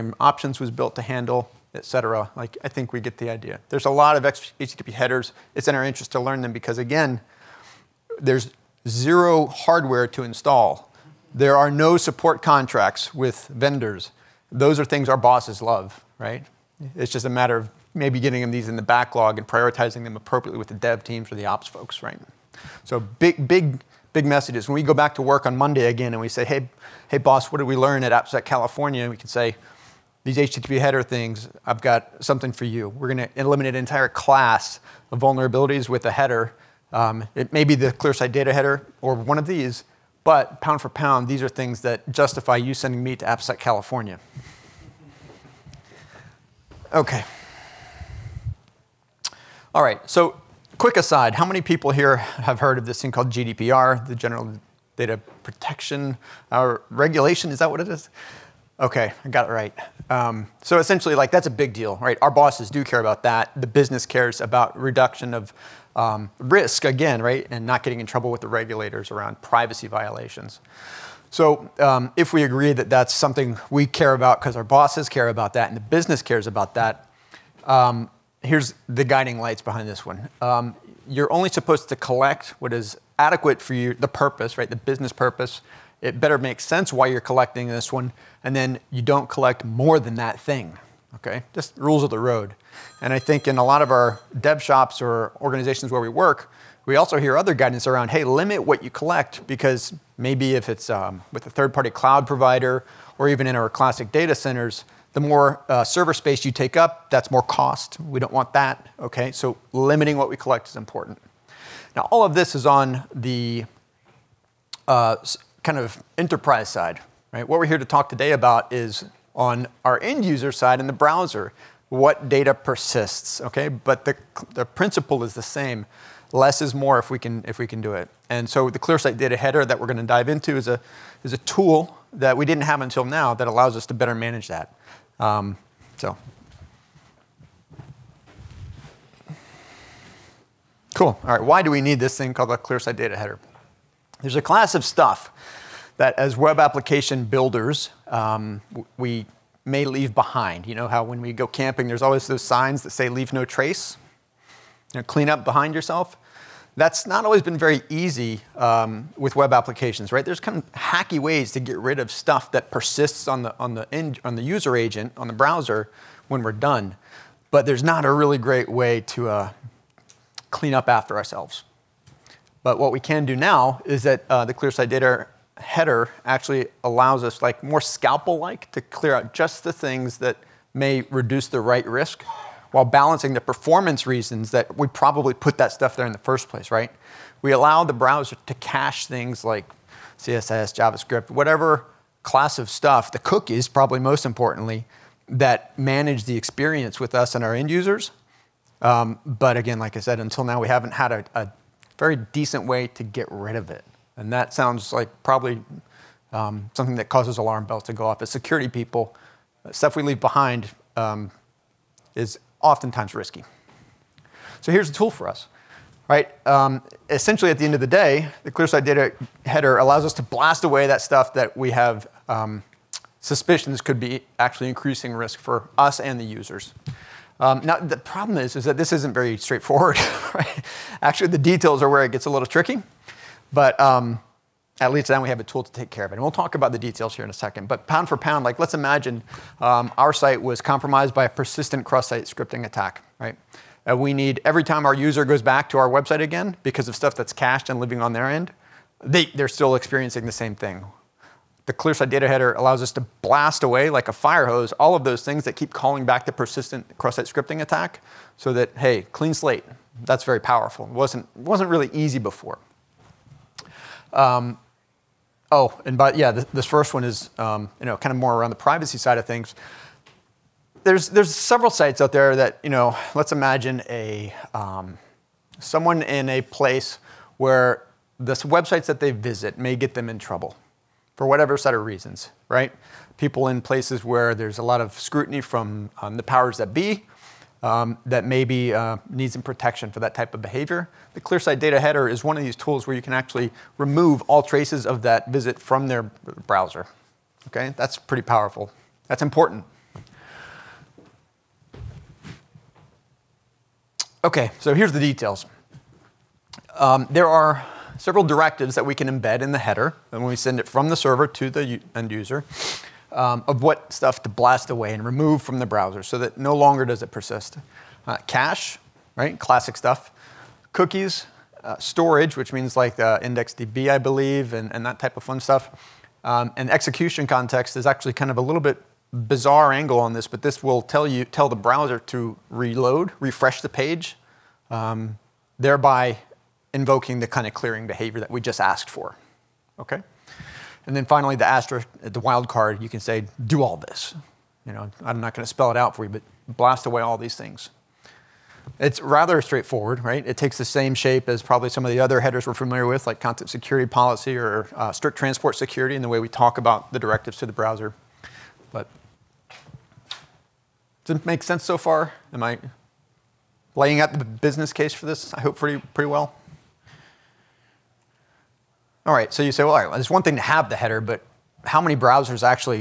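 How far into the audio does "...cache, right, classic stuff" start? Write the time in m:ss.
5:18.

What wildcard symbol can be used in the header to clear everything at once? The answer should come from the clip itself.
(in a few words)
Asterisk.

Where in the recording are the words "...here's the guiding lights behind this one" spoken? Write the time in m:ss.
1:18.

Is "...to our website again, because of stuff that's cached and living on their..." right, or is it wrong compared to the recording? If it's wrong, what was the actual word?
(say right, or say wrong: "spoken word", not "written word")
right.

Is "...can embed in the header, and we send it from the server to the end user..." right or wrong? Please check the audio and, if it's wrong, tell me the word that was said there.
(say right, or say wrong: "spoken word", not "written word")
right.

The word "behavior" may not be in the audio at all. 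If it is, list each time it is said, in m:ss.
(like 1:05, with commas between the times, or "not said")
4:50, 5:37.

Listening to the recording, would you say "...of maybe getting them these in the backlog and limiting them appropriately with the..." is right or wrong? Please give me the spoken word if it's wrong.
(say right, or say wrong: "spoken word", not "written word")
wrong: "prioritizing", not "limiting".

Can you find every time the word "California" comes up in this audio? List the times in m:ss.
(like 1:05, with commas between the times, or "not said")
0:28, 0:43.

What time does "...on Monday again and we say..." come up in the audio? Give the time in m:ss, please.
0:25.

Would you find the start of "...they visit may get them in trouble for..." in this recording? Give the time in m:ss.
4:39.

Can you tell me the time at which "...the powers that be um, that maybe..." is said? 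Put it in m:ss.
4:46.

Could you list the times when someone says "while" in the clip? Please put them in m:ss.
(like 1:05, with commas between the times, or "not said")
3:02.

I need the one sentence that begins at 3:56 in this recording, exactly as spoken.
And we'll talk about the details here in a second.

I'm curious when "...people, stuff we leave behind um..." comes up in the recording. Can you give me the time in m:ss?
3:28.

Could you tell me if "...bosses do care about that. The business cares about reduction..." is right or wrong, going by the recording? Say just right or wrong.
right.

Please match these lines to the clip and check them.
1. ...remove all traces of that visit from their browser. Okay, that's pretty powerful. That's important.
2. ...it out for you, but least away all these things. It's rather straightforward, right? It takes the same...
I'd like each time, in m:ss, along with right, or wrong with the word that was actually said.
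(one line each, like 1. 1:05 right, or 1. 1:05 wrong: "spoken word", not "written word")
1. 4:53 right
2. 5:45 wrong: "blast", not "least".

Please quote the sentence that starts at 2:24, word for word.
There's a class of stuff that, as web application builders, um, we may leave behind.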